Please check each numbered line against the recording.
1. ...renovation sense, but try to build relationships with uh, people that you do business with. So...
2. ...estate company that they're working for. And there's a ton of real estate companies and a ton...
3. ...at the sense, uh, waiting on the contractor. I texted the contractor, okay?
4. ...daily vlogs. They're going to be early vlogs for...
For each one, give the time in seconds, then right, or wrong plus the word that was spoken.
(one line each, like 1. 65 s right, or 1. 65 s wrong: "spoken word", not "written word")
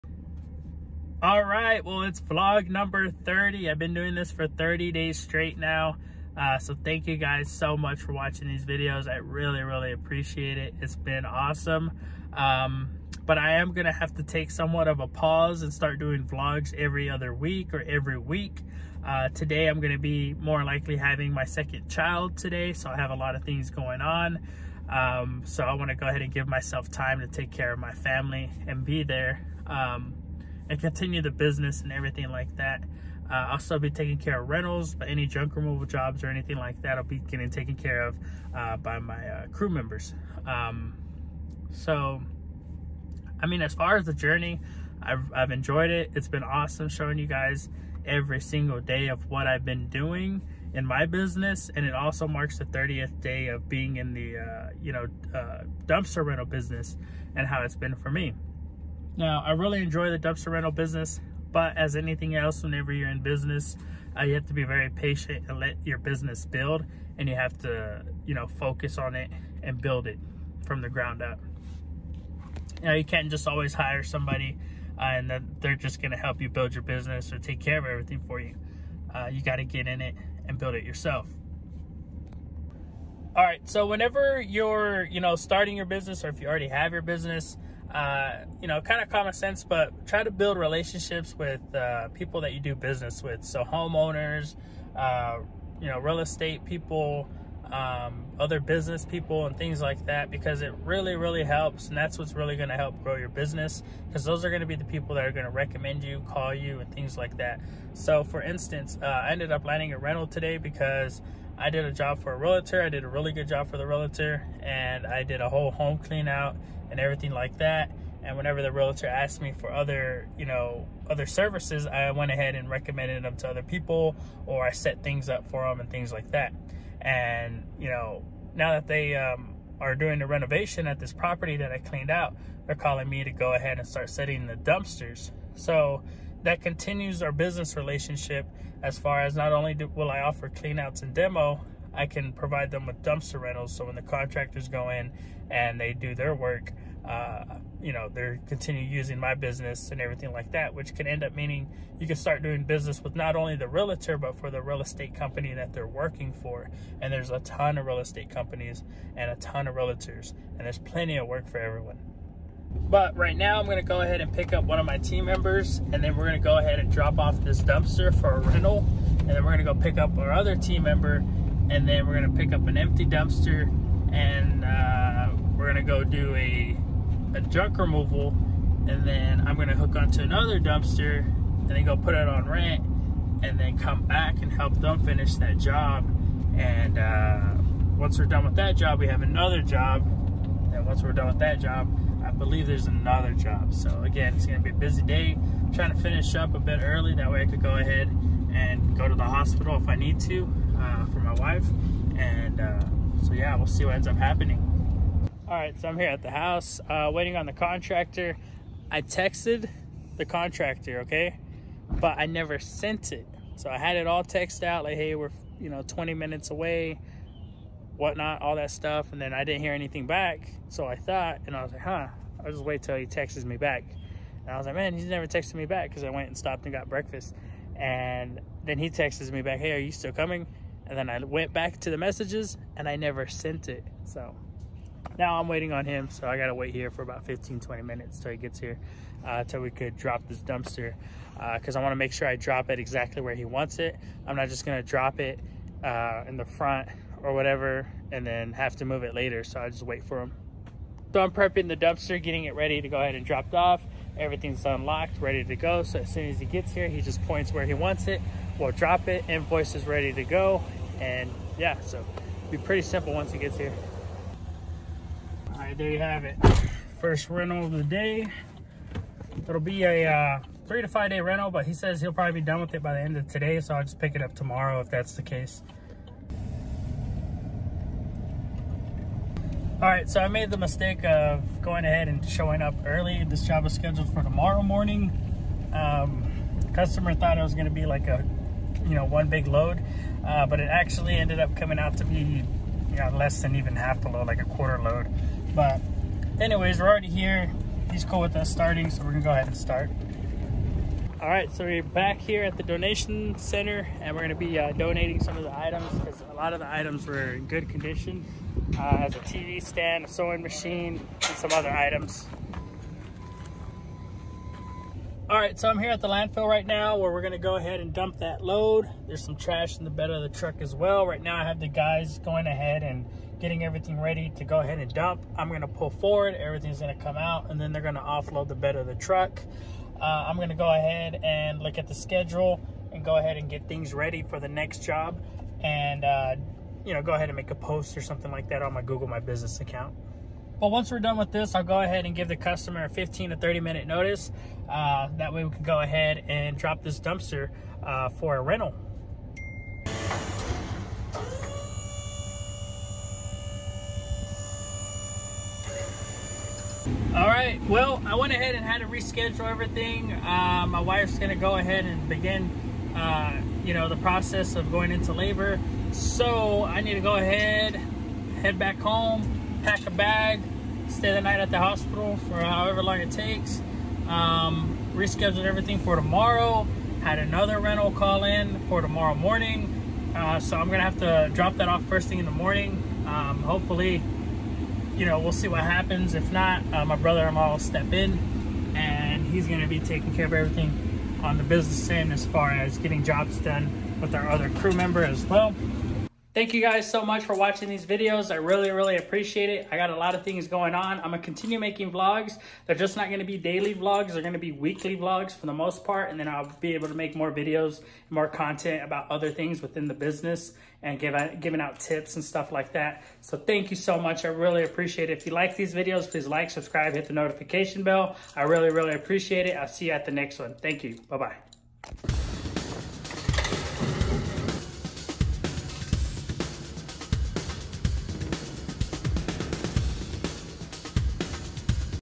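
1. 89 s wrong: "common", not "renovation"
2. 154 s right
3. 206 s wrong: "house", not "sense"
4. 403 s wrong: "weekly", not "early".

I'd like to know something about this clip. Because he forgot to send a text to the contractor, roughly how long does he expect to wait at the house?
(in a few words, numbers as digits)
15 to 20 minutes.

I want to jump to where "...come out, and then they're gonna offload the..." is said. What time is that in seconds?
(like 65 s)
326 s.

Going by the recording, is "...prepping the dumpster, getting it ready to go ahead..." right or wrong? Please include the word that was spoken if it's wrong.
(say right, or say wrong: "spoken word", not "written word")
right.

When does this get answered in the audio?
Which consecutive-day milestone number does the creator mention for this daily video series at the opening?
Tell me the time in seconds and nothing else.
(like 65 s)
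2 s.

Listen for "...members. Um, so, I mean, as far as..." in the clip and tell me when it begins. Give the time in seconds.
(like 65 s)
39 s.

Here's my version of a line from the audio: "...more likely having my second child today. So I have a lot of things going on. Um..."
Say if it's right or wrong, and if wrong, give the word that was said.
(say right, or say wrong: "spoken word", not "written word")
right.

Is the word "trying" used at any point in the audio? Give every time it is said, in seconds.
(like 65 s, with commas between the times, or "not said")
195 s.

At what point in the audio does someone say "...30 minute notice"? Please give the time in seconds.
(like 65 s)
343 s.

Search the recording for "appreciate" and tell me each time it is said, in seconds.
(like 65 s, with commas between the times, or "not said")
9 s, 398 s, 414 s, 418 s.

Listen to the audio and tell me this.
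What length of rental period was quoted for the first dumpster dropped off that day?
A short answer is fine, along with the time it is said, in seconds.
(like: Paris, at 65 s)
3 to 5 days, at 270 s.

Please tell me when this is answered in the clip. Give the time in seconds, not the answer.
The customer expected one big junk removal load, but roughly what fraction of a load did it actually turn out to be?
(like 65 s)
294 s.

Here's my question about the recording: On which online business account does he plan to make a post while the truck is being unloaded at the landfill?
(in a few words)
Google My Business.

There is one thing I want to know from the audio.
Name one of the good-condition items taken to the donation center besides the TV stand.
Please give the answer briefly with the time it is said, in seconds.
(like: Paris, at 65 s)
A sewing machine, at 310 s.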